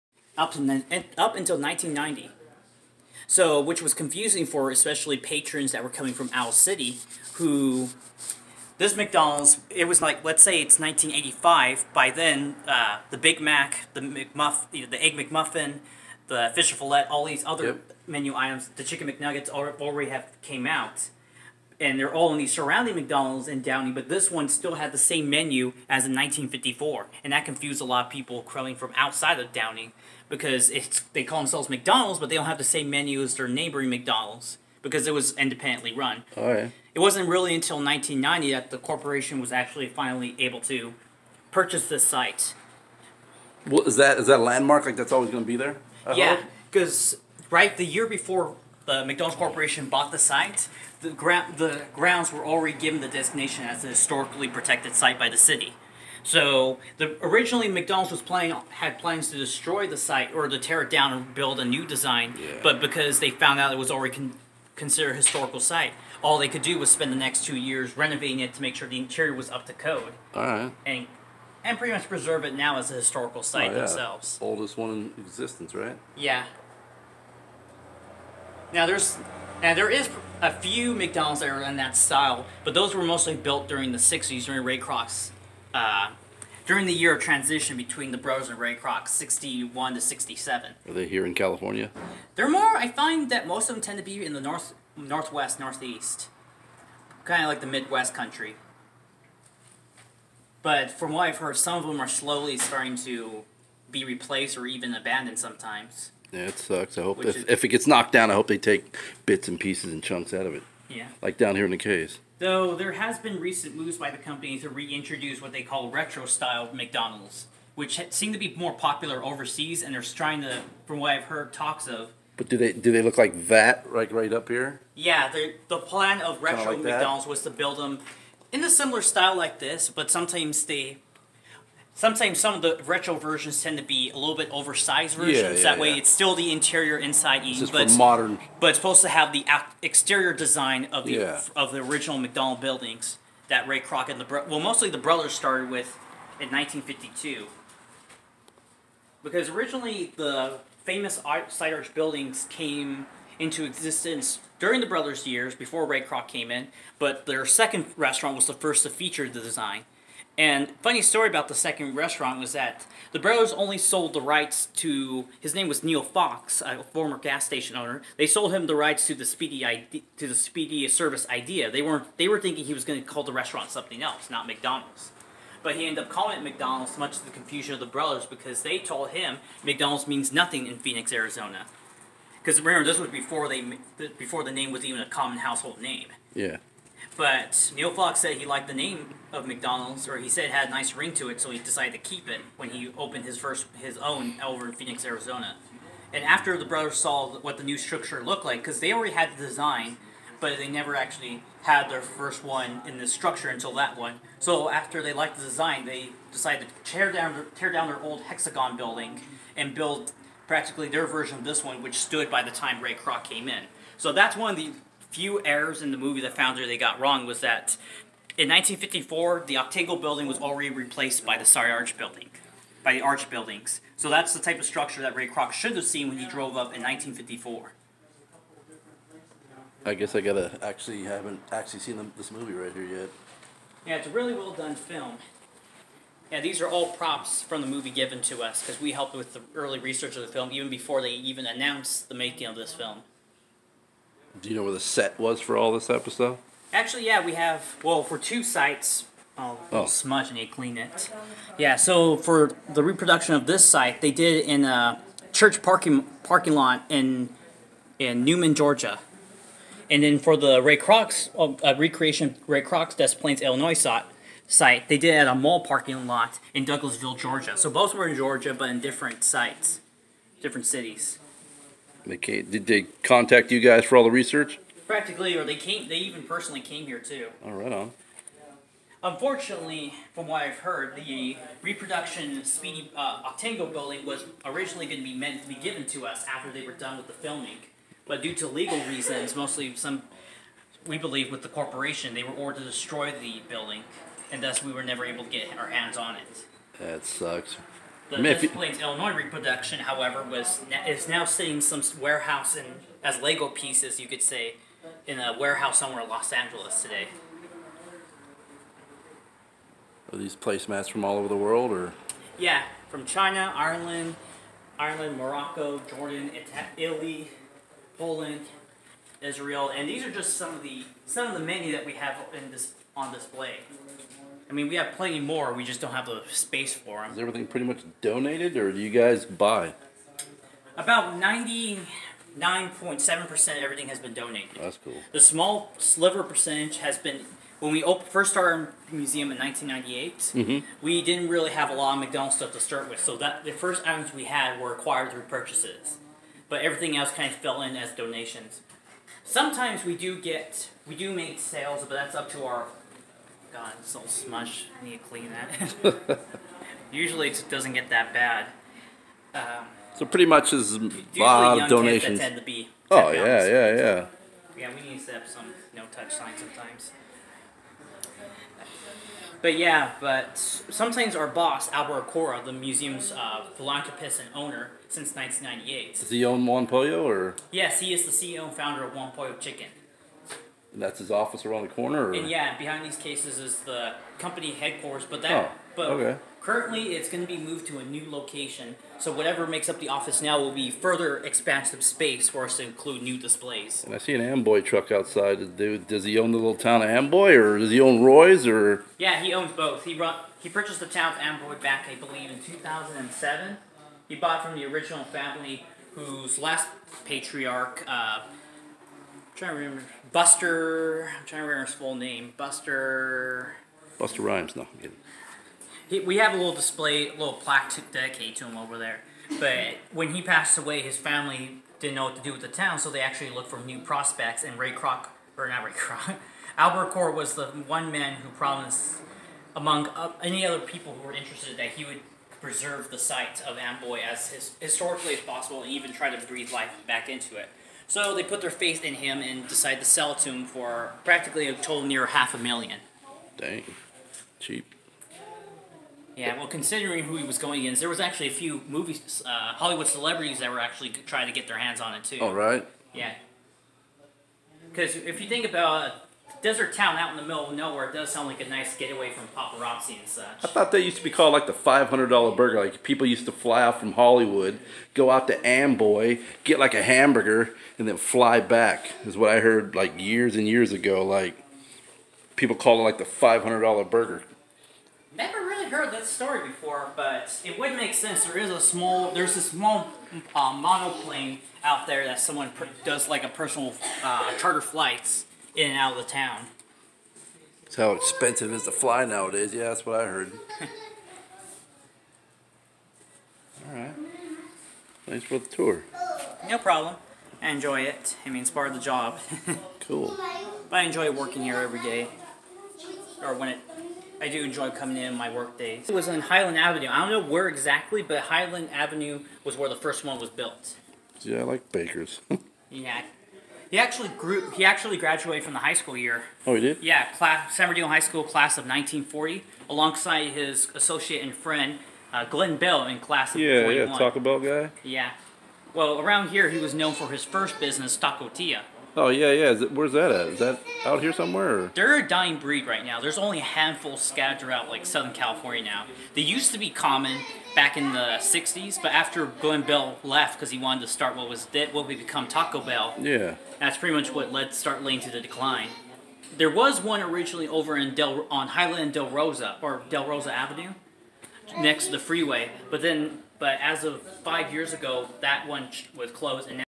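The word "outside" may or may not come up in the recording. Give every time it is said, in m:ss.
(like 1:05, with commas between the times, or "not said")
0:28, 6:34.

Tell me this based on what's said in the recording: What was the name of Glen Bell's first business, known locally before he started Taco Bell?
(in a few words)
Taco Tia.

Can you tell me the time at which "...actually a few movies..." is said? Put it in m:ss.
7:27.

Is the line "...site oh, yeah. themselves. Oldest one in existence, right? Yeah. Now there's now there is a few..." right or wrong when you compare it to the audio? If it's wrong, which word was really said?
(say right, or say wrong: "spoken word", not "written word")
right.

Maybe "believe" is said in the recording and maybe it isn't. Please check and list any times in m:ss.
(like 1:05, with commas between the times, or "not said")
4:50, 6:41.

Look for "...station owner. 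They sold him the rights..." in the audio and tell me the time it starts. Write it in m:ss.
2:47.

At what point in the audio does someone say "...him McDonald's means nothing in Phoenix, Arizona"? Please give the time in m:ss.
2:59.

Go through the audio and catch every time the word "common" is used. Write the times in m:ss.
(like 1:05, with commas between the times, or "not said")
3:05, 8:56.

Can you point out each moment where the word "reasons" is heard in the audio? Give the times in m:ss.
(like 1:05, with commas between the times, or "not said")
4:48.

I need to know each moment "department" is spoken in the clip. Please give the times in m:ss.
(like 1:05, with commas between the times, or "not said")
not said.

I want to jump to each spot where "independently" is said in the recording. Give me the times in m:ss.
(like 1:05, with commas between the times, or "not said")
0:35.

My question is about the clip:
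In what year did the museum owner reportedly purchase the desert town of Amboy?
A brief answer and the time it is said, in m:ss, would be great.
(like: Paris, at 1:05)
2007, at 6:42.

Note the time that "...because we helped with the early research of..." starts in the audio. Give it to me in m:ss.
3:58.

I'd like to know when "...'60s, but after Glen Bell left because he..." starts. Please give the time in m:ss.
8:58.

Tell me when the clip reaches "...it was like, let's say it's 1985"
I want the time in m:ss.
0:09.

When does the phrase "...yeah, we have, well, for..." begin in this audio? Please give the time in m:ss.
4:07.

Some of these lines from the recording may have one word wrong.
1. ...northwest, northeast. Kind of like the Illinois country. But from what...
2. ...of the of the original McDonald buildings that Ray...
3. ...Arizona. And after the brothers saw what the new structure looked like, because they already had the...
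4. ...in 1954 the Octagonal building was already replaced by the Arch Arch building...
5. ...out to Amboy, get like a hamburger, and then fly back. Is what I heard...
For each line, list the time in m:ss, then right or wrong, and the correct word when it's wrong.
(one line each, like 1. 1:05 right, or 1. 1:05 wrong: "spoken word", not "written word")
1. 1:34 wrong: "Midwest", not "Illinois"
2. 2:20 right
3. 3:15 right
4. 3:38 wrong: "Sorry", not "Arch"
5. 7:45 right.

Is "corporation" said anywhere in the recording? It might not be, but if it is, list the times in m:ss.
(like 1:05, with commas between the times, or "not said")
0:38, 0:49, 4:51.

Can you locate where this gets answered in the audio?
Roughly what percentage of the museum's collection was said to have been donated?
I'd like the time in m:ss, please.
5:31.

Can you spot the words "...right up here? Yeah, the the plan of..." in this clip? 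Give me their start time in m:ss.
2:04.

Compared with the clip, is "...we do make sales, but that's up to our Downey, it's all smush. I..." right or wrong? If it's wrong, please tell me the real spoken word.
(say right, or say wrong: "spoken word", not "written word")
wrong: "God", not "Downey".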